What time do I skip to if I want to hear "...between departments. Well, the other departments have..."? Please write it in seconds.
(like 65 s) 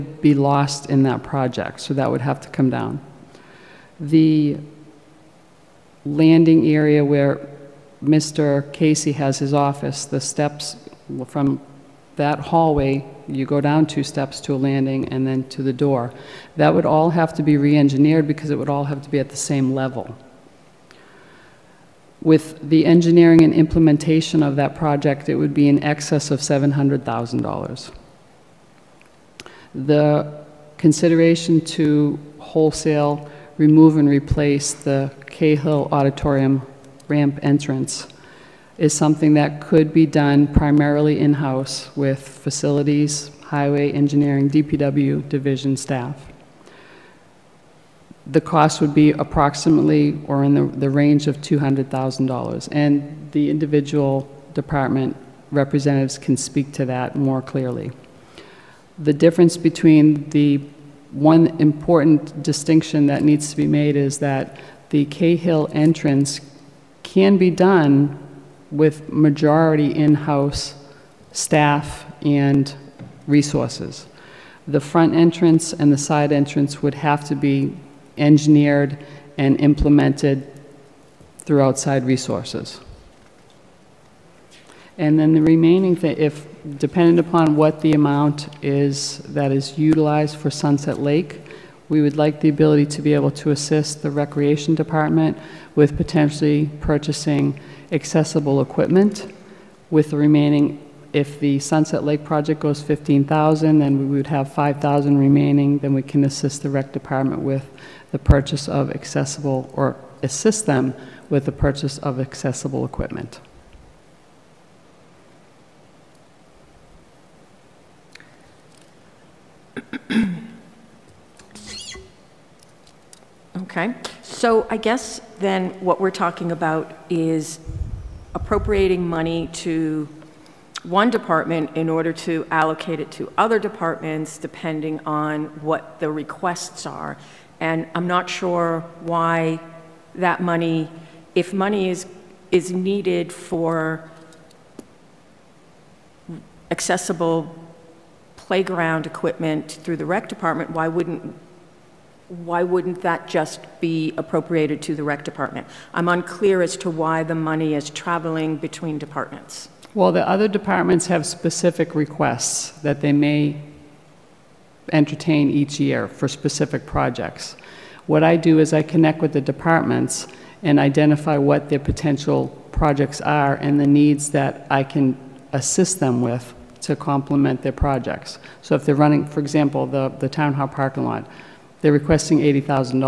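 158 s.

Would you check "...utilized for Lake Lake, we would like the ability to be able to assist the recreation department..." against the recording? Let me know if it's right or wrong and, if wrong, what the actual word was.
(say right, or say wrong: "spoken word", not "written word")
wrong: "Sunset", not "Lake".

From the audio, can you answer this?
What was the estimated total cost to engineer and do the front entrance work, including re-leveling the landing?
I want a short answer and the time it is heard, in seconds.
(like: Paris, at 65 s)
In excess of $700,000, at 25 s.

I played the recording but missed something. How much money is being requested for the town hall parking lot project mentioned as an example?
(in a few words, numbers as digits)
$80,000.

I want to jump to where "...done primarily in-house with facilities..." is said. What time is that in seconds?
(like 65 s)
40 s.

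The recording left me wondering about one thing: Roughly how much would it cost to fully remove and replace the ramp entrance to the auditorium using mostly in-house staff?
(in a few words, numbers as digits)
$200,000.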